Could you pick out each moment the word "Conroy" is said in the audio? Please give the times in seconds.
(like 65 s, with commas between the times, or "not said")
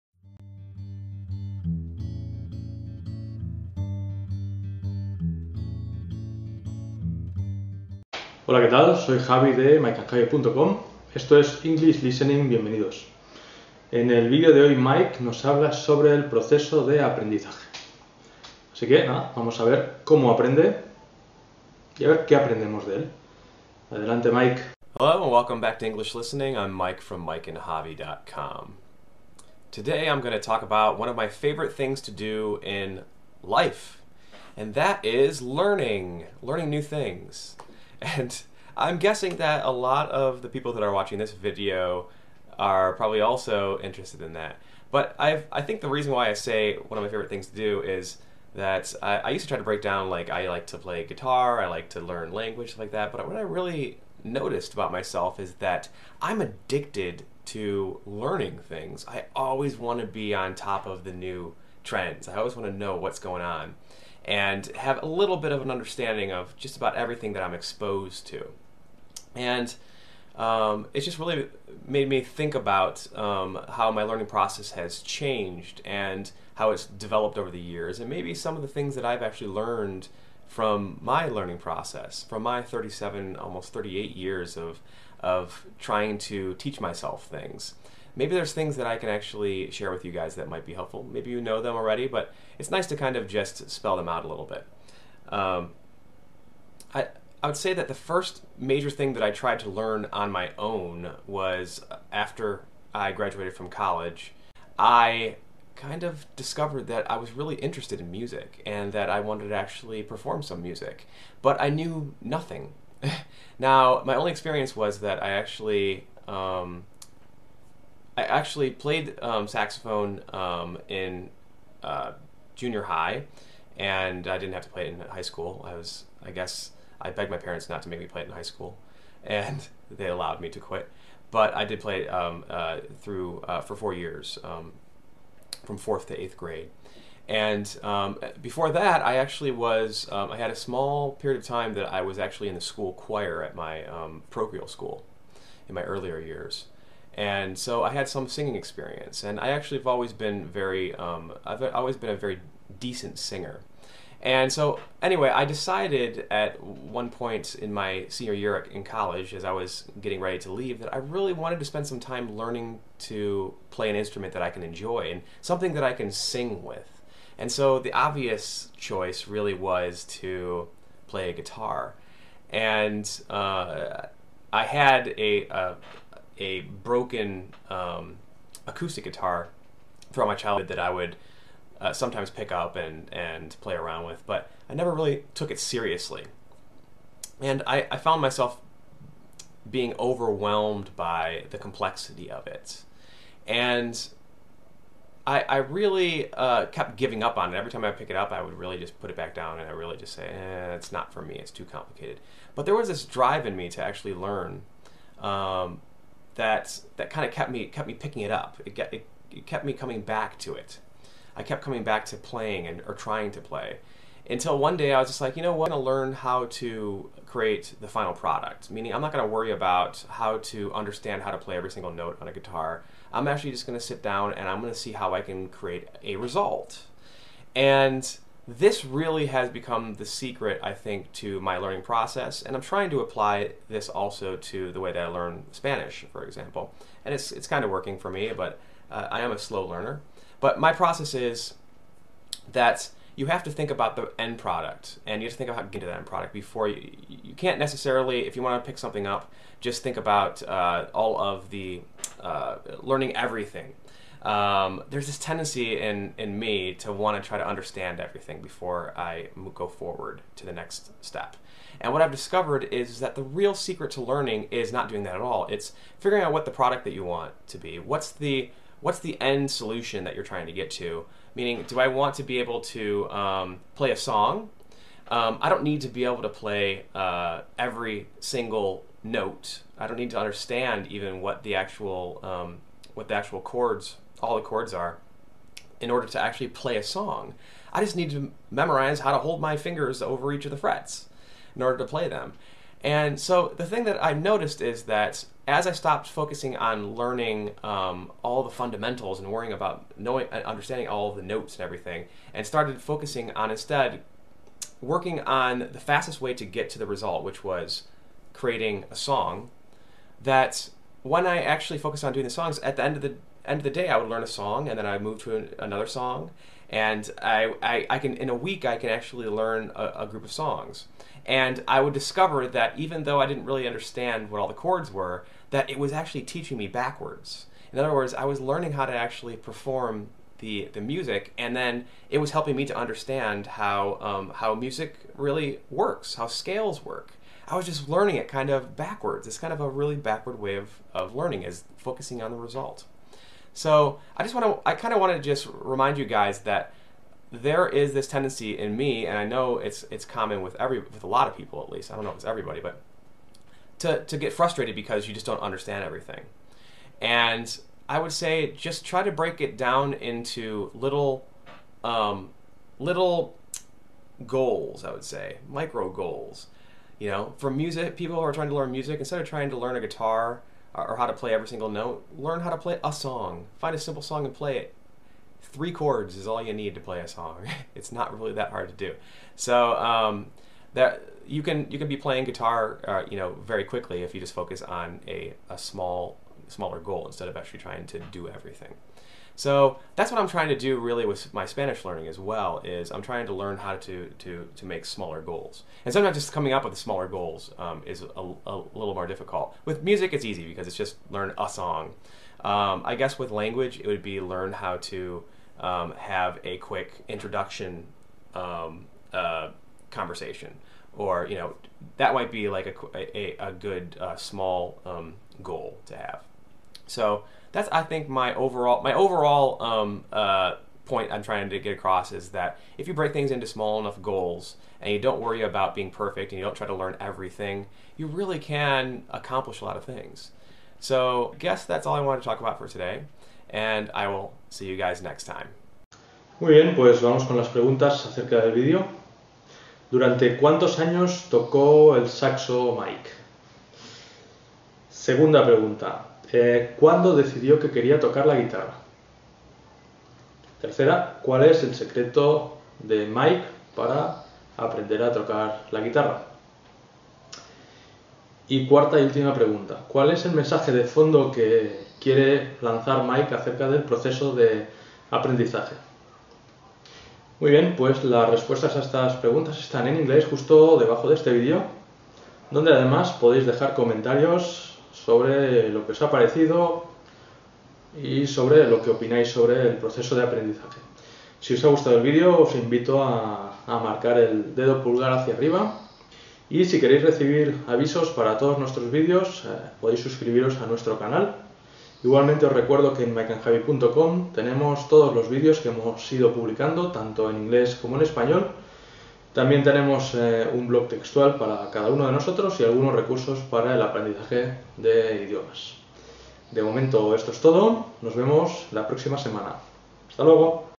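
not said.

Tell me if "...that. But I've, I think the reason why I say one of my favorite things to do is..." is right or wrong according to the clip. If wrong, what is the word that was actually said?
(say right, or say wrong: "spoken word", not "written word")
right.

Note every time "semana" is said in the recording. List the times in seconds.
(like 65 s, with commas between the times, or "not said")
509 s.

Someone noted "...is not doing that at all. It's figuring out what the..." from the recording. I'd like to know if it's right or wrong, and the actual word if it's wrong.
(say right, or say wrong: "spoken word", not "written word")
right.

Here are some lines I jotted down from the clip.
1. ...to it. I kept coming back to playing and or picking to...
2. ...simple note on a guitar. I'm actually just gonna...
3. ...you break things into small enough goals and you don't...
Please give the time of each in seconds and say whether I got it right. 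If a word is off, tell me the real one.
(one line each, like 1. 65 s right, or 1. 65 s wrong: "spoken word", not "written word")
1. 210 s wrong: "trying", not "picking"
2. 221 s wrong: "single", not "simple"
3. 422 s right.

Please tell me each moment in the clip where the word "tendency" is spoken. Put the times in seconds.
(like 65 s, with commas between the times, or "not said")
255 s, 348 s.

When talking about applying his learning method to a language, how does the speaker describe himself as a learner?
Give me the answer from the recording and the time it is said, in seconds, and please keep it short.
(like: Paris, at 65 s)
a slow learner, at 239 s.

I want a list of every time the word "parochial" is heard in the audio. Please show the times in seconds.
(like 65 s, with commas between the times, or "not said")
144 s.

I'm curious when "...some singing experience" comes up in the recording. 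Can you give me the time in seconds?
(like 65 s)
148 s.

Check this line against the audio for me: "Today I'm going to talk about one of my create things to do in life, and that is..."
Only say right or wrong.
wrong.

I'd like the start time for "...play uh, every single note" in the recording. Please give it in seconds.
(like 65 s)
276 s.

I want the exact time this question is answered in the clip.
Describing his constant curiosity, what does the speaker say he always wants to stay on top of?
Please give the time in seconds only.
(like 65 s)
61 s.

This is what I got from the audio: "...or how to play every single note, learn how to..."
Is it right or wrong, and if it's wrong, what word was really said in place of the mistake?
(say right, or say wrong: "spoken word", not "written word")
right.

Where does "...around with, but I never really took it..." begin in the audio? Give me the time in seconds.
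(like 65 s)
183 s.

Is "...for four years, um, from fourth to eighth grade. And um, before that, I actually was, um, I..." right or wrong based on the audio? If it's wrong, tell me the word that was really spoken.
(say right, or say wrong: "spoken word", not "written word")
right.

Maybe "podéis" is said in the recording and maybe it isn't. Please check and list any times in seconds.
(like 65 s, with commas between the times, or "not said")
473 s, 489 s.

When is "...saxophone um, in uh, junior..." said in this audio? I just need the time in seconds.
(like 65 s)
119 s.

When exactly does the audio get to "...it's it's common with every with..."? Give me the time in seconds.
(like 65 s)
349 s.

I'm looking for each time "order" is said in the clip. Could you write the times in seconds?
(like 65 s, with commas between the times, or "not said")
285 s, 291 s.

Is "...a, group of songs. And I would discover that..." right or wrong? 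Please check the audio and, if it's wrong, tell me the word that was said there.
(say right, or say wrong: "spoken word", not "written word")
right.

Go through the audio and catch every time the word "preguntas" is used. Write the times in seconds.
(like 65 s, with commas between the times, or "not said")
437 s, 445 s, 459 s, 469 s.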